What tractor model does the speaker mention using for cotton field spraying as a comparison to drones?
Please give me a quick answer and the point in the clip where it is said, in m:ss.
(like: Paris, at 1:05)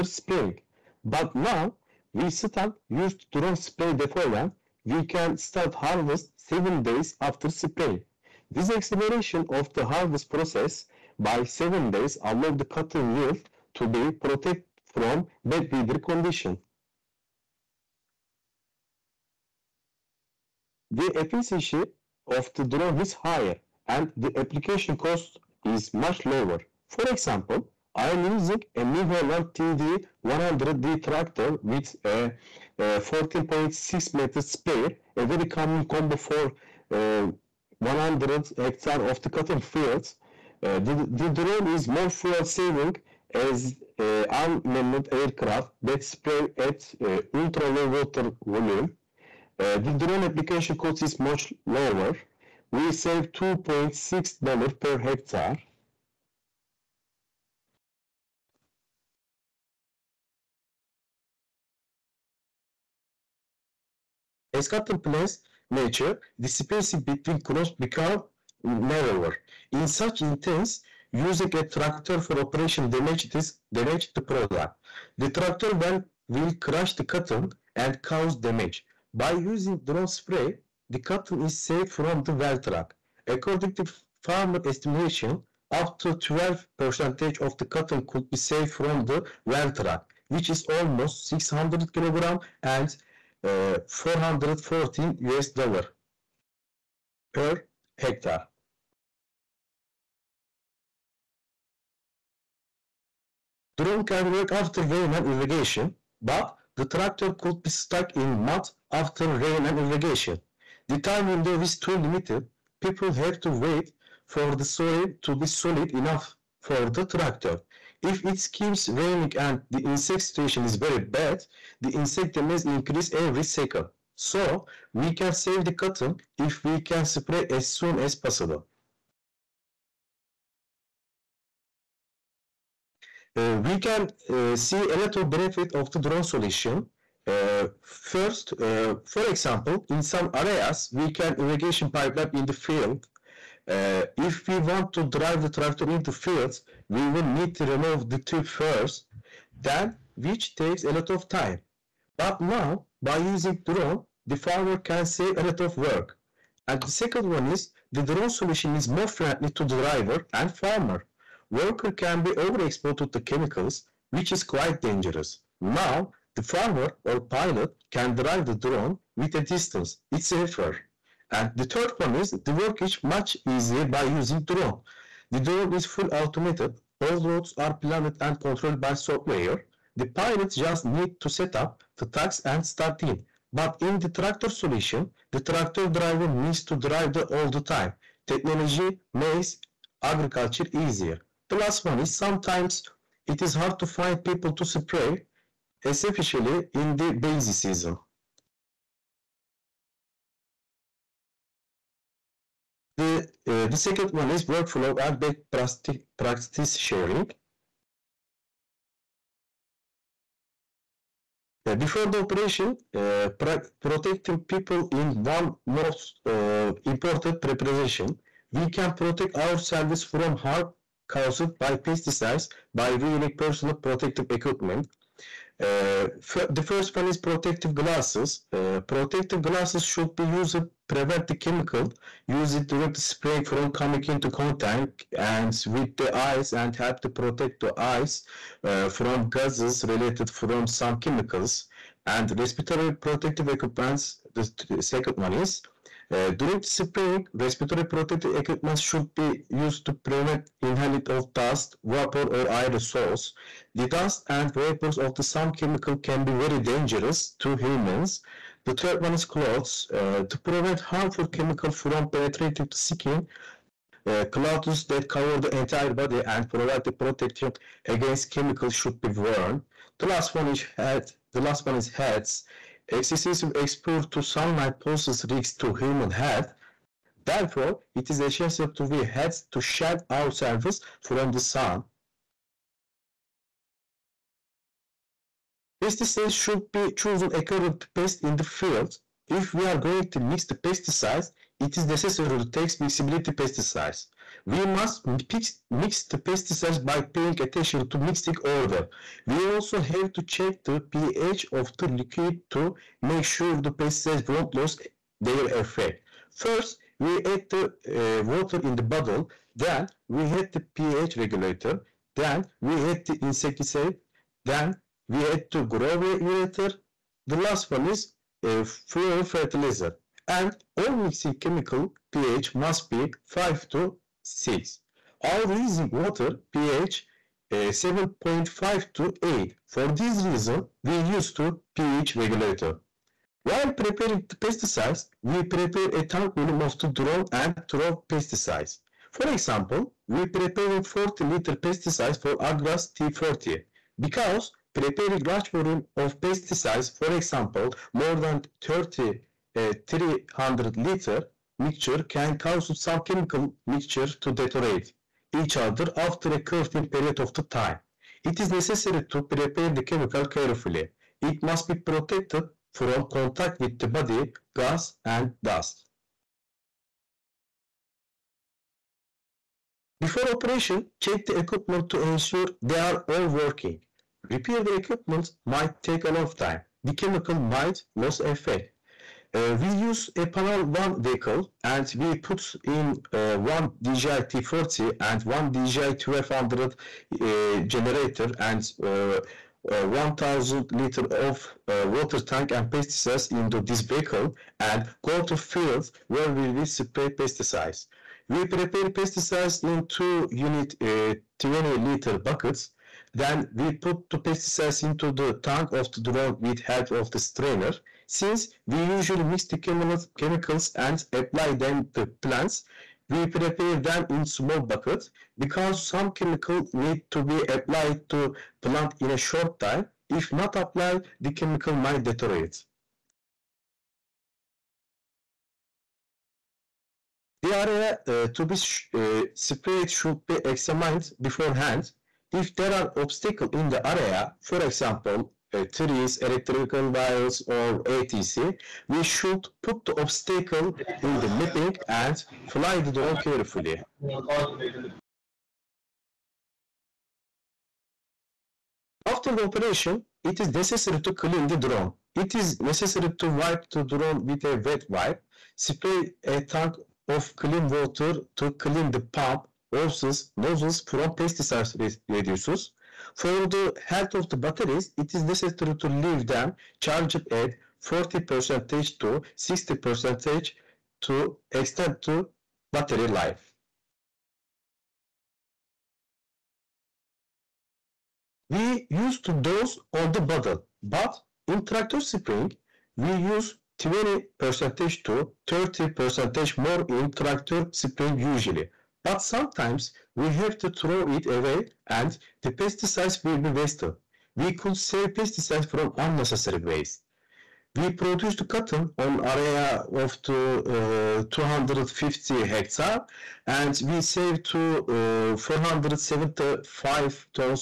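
New Holland TD100D, at 0:28.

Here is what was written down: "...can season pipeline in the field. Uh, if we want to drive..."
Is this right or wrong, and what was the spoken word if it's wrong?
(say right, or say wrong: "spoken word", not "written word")
wrong: "irrigation", not "season".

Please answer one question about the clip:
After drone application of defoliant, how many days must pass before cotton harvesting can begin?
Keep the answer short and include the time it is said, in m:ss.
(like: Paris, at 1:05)
7 days, at 0:06.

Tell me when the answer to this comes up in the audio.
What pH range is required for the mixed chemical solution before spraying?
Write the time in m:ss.
5:23.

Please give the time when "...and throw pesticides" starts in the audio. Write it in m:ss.
5:37.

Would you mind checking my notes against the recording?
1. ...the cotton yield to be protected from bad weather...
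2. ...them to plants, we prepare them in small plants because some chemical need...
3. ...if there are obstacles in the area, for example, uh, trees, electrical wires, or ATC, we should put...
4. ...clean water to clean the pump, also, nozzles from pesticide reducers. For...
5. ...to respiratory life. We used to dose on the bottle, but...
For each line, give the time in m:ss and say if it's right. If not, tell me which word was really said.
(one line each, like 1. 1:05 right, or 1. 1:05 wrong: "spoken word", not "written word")
1. 0:12 right
2. 6:51 wrong: "buckets", not "plants"
3. 7:12 right
4. 7:37 right
5. 7:52 wrong: "battery", not "respiratory".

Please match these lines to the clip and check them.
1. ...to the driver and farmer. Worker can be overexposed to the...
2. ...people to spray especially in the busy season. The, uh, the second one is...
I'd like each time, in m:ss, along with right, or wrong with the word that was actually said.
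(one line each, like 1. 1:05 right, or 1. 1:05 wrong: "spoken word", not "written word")
1. 2:39 right
2. 3:14 right.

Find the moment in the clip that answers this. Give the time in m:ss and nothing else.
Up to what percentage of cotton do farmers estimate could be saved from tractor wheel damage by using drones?
1:26.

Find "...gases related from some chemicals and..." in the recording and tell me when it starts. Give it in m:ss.
3:59.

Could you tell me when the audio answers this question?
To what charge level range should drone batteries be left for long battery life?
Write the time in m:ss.
7:47.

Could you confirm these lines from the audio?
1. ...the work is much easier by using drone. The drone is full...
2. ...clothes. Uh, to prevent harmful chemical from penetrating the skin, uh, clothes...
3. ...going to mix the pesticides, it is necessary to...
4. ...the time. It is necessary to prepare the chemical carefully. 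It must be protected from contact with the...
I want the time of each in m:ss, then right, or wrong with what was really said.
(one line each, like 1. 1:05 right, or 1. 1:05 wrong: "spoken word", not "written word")
1. 2:52 right
2. 4:19 right
3. 4:49 right
4. 5:57 right.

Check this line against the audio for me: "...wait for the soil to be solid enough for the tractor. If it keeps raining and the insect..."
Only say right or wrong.
right.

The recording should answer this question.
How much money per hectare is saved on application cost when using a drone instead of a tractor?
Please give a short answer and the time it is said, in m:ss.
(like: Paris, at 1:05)
$2.6, at 0:53.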